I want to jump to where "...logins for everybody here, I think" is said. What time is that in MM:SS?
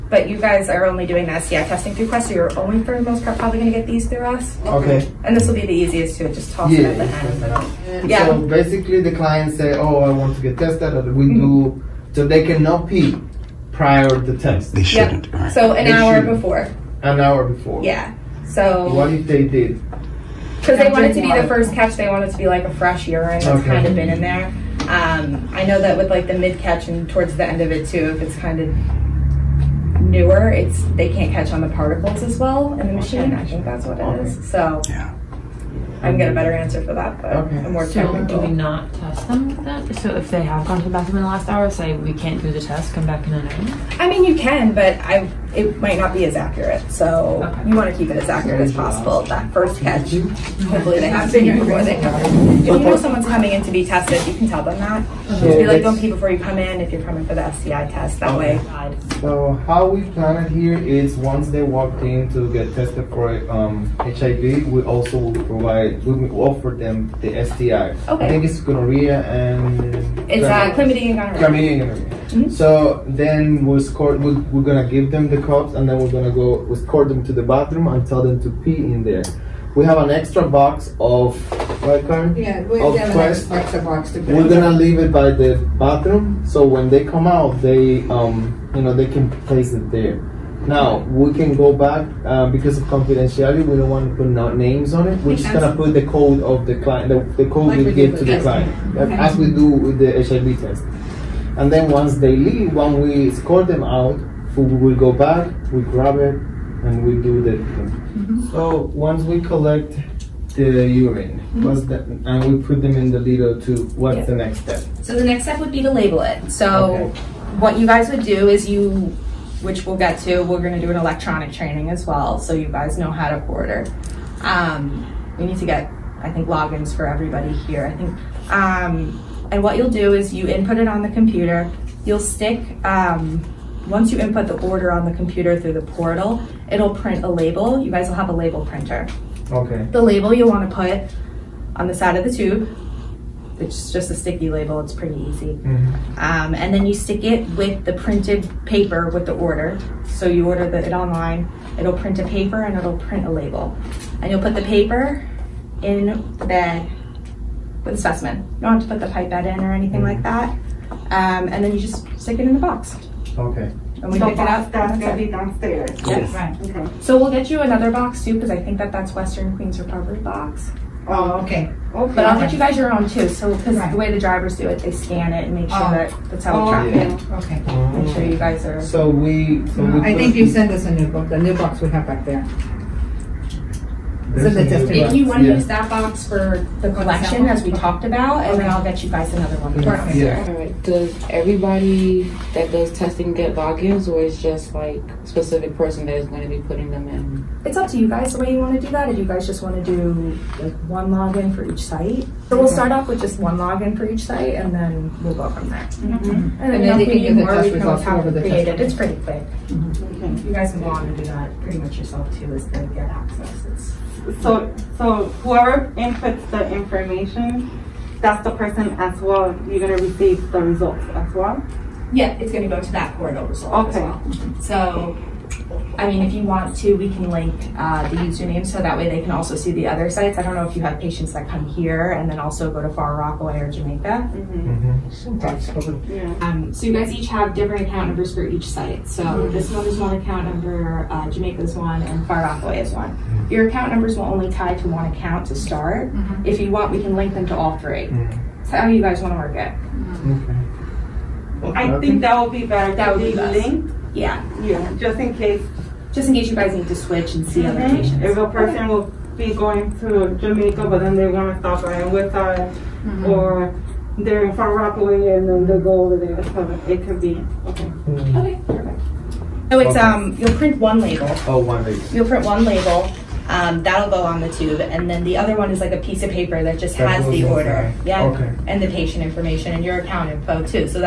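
02:06.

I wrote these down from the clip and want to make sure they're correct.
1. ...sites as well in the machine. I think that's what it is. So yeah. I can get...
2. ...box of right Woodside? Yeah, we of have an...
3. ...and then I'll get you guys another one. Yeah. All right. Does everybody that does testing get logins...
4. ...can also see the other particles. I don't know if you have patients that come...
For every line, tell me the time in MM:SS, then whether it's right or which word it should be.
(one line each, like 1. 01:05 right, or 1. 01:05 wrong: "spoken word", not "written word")
1. 00:31 wrong: "particles", not "sites"
2. 01:20 wrong: "Karen", not "Woodside"
3. 03:08 right
4. 03:49 wrong: "sites", not "particles".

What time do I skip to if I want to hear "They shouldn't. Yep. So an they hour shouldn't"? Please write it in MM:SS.
00:14.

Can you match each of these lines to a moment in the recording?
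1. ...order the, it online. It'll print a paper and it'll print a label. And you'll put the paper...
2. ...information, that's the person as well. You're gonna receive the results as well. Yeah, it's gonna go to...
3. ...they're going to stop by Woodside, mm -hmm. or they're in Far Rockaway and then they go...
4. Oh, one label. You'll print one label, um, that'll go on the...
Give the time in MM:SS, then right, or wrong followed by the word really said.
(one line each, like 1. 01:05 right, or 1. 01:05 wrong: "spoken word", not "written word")
1. 02:30 right
2. 03:36 right
3. 04:21 right
4. 04:31 right.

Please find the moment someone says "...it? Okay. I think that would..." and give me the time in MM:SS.
04:09.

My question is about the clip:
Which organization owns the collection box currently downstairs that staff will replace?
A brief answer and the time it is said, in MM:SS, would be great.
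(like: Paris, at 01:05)
Western Queens Recovery, at 02:49.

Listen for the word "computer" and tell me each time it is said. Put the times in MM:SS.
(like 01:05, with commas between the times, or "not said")
02:11, 02:15.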